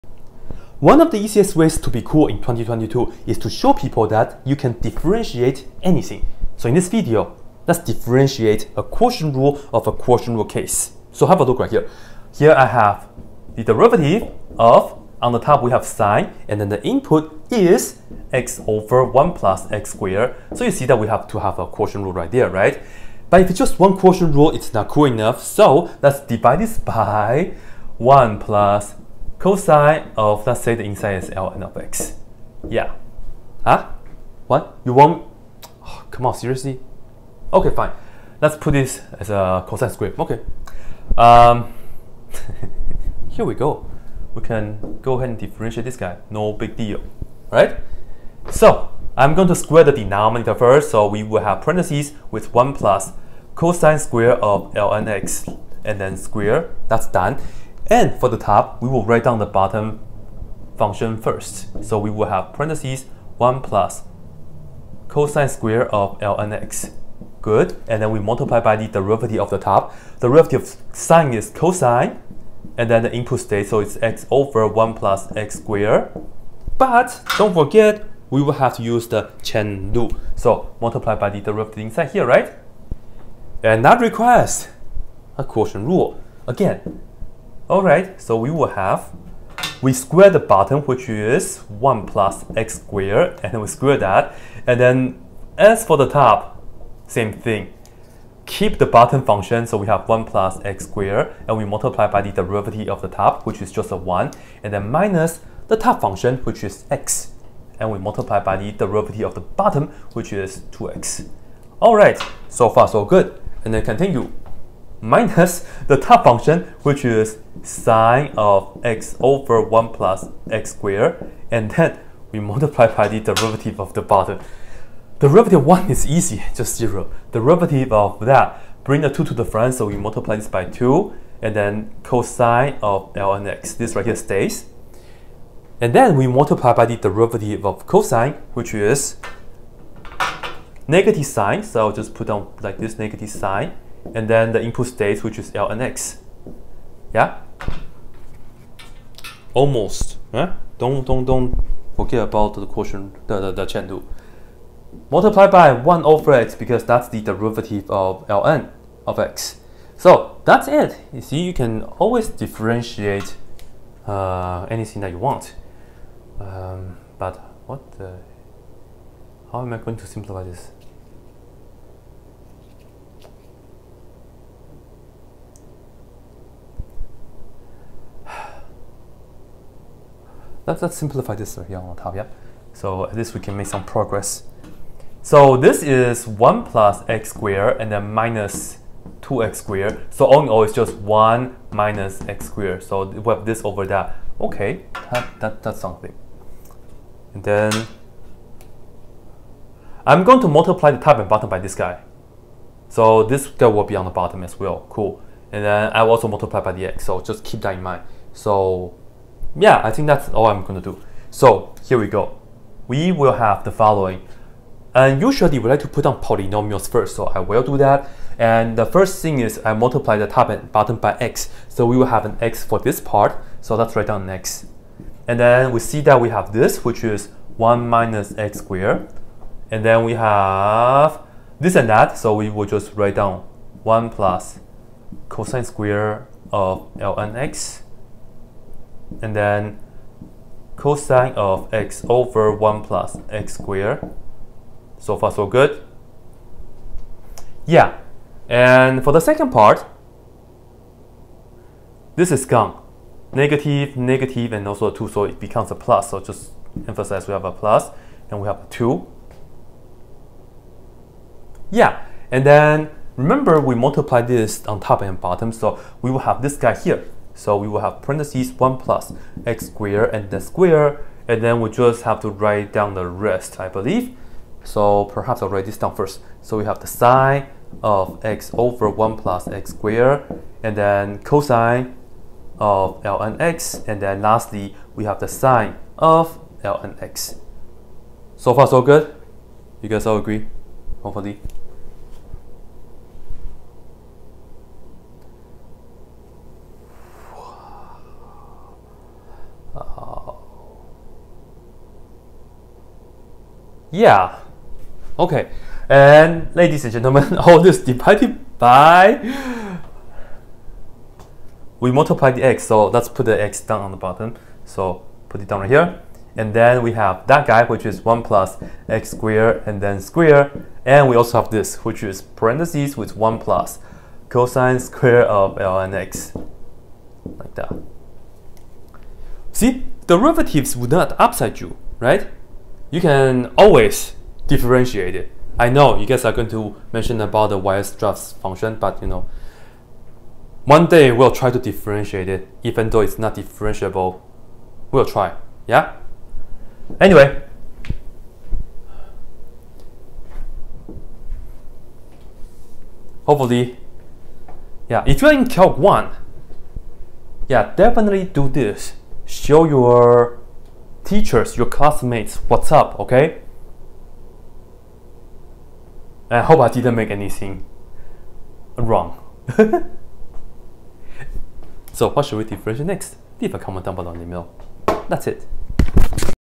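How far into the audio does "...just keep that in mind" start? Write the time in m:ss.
3:27.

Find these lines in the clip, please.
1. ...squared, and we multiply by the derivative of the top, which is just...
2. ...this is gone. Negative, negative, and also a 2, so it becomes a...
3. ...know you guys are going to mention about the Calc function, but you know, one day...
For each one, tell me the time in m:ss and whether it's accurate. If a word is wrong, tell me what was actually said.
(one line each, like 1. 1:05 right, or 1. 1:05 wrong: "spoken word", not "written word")
1. 1:40 right
2. 4:12 right
3. 5:35 wrong: "Weierstrass", not "Calc".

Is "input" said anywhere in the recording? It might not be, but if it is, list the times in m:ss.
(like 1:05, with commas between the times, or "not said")
0:16, 1:13, 2:24.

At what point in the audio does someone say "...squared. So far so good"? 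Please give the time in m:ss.
4:03.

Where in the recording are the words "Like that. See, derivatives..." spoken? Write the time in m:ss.
5:27.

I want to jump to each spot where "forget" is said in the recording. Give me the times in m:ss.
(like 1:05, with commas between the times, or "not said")
1:17, 2:31.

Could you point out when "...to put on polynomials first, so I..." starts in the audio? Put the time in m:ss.
3:35.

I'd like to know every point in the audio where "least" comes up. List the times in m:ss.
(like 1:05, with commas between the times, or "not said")
3:03.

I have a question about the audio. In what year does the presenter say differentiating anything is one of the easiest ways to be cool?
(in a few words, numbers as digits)
2022.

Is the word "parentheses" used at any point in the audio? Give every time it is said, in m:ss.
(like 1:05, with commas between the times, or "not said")
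0:51, 1:02, 4:28, 5:22.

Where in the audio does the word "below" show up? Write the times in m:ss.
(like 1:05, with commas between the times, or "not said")
6:13.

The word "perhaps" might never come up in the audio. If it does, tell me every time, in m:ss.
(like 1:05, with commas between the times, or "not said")
4:35.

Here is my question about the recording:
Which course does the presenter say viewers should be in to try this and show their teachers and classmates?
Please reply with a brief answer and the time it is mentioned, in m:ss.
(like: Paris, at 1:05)
Calc 1, at 5:55.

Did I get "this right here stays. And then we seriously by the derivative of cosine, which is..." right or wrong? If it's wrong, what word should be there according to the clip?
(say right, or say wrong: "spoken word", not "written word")
wrong: "multiply", not "seriously".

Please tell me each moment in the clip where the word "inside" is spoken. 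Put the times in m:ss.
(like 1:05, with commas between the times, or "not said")
0:30, 1:21.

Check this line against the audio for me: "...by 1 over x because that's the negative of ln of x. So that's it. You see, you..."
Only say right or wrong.
wrong.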